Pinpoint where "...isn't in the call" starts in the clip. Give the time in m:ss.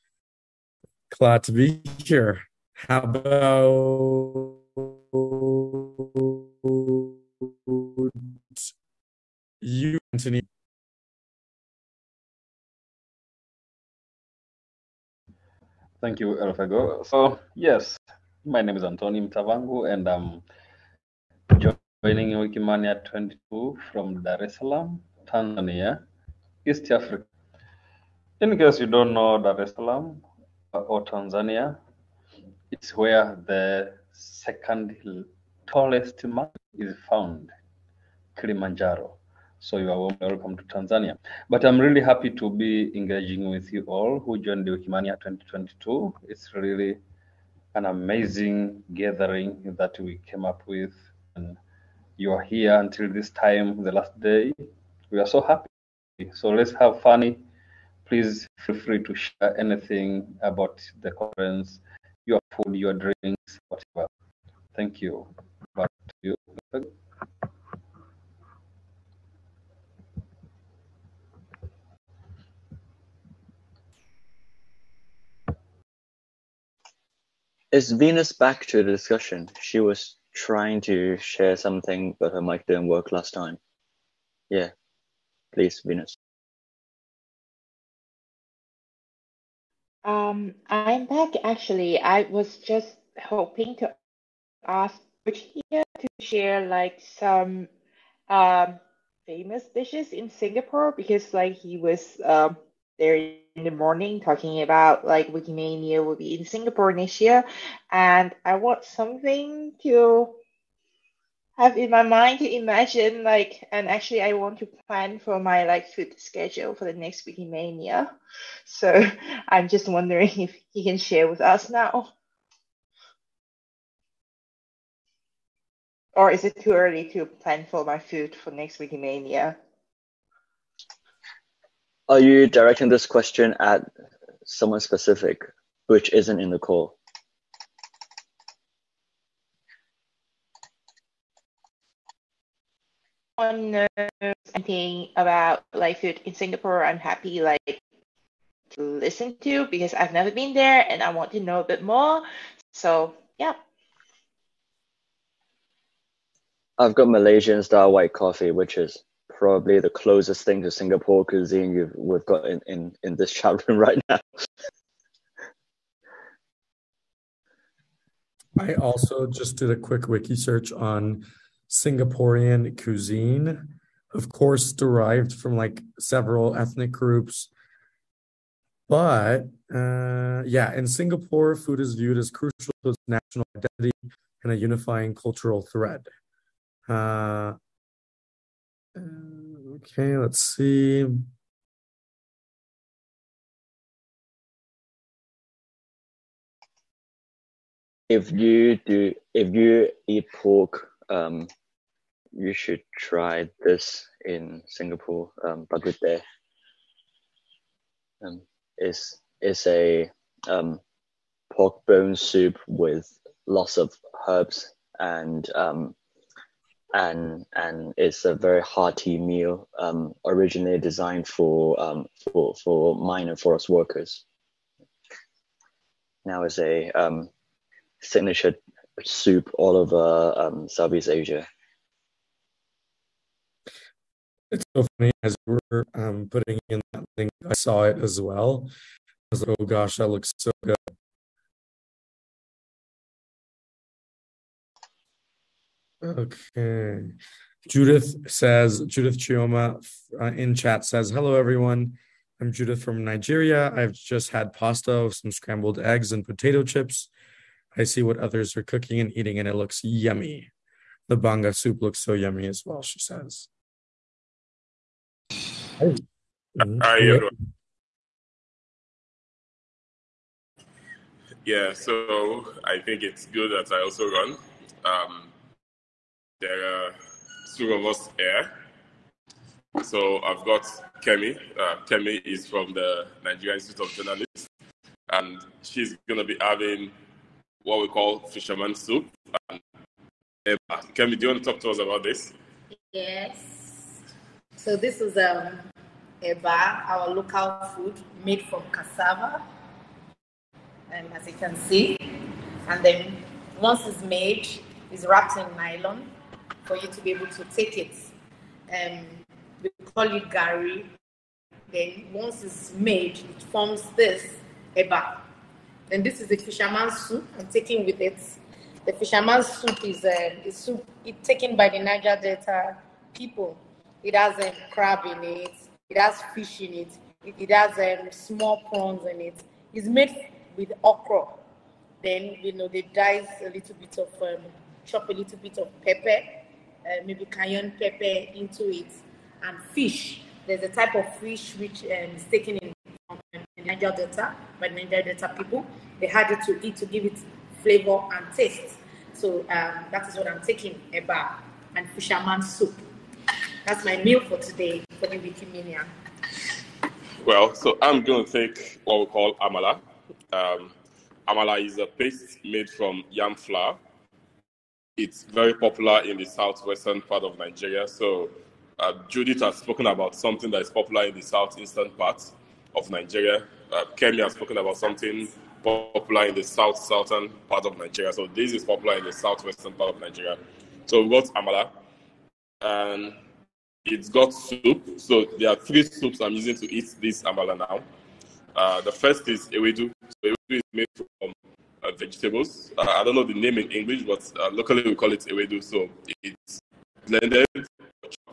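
2:16.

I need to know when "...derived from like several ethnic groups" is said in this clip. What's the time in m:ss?
2:54.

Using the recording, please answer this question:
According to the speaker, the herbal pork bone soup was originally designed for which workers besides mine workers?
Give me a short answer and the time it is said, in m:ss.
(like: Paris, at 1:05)
Forest workers, at 3:43.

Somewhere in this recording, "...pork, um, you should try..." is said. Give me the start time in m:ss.
3:20.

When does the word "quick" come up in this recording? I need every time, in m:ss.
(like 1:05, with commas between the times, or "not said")
2:49.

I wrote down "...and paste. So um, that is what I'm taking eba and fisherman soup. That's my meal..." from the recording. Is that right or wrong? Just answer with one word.
wrong.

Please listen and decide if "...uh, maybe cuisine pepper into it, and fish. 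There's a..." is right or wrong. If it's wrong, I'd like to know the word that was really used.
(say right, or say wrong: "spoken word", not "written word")
wrong: "cayenne", not "cuisine".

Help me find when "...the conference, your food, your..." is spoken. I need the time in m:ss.
1:01.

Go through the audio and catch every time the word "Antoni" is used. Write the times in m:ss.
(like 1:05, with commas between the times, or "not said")
0:18.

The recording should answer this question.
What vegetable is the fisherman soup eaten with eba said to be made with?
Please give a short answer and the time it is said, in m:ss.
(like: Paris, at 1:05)
Okra, at 5:30.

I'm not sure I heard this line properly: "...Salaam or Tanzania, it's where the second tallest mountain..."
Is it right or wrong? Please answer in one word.
right.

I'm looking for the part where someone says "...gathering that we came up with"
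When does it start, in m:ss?
0:48.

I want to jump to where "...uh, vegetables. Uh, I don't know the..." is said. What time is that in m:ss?
6:31.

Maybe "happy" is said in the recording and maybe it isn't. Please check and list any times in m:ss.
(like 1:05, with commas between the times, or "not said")
0:42, 0:55, 2:26.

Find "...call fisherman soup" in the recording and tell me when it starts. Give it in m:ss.
4:47.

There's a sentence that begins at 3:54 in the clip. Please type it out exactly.
It's so funny as we are um, putting in that link, I saw it as well.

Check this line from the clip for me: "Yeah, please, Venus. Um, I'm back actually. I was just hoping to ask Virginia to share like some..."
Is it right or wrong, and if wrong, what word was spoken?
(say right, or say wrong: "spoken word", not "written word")
right.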